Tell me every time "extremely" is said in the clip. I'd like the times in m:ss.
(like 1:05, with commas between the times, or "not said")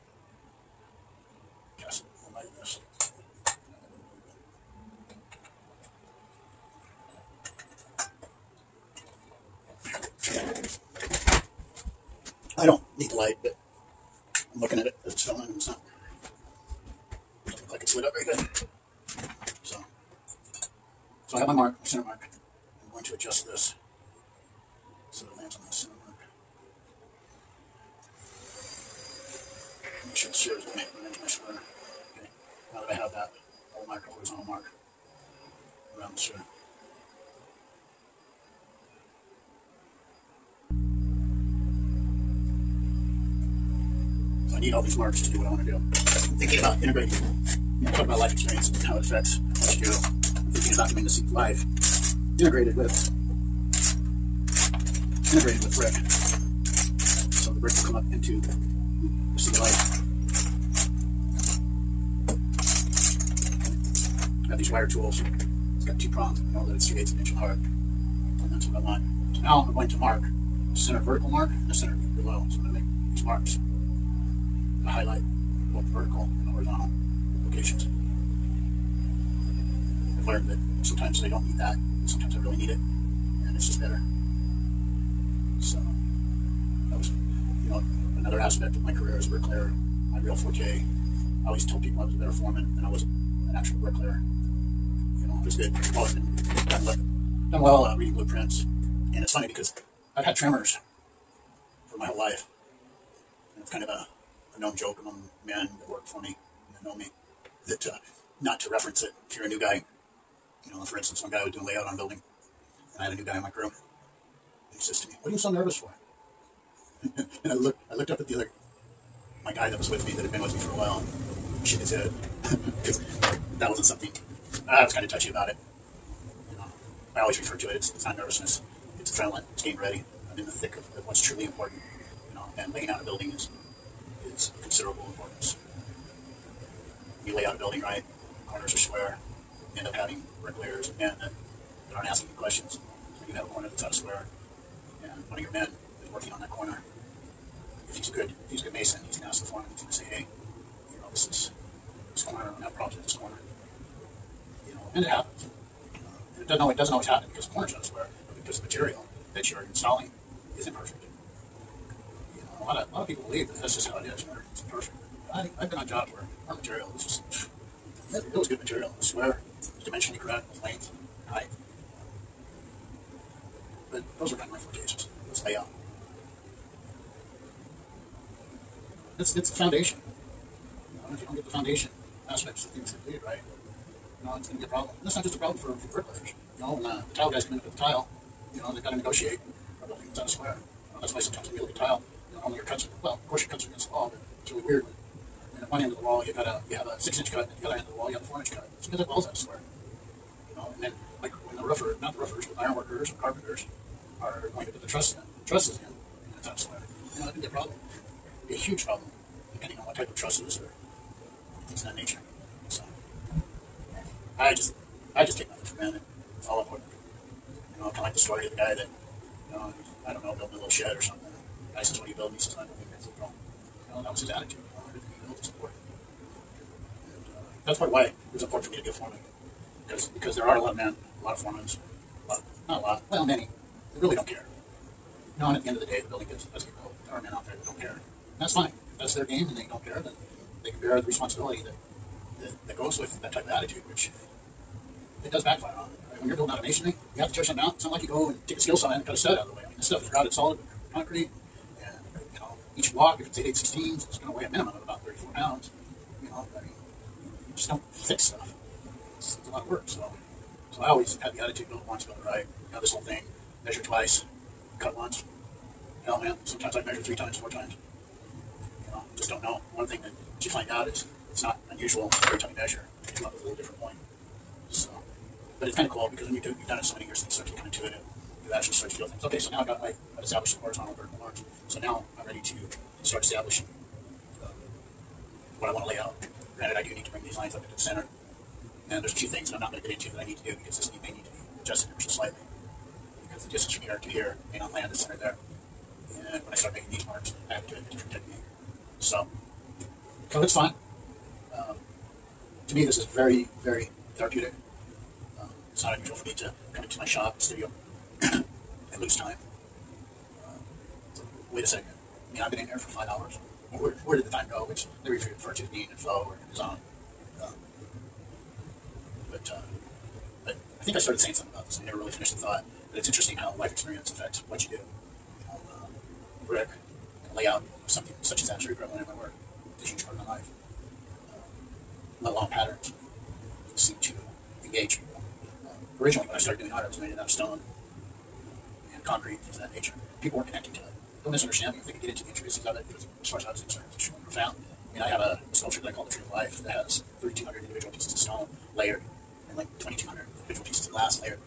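5:43.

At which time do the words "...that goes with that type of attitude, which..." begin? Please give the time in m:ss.
4:02.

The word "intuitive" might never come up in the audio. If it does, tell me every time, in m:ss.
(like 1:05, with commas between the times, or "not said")
4:37.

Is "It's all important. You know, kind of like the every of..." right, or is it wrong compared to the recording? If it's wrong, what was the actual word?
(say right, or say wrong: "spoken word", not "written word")
wrong: "story", not "every".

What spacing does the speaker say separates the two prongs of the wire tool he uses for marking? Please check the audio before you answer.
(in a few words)
3/8 inch.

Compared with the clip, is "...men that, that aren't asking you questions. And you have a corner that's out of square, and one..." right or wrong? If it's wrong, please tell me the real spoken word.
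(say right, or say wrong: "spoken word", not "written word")
right.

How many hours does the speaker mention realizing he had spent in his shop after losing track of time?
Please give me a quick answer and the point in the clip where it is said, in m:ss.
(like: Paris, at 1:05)
5, at 5:12.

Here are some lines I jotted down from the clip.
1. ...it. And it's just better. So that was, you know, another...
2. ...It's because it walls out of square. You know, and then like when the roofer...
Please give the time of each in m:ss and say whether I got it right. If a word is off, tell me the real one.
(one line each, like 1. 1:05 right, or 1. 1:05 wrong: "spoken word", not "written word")
1. 1:22 right
2. 3:18 right.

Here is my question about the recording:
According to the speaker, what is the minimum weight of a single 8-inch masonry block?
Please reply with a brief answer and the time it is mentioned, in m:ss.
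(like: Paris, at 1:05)
34 pounds, at 4:15.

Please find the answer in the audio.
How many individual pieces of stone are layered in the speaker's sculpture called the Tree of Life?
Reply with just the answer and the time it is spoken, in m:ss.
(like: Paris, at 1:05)
3,200, at 5:47.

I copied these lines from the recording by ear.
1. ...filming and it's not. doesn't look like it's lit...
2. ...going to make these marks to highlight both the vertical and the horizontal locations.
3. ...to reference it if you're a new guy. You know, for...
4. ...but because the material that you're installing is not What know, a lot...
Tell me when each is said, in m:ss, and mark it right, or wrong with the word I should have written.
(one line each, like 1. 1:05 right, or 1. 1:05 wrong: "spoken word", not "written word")
1. 0:15 right
2. 1:12 right
3. 1:48 right
4. 2:38 wrong: "You", not "What".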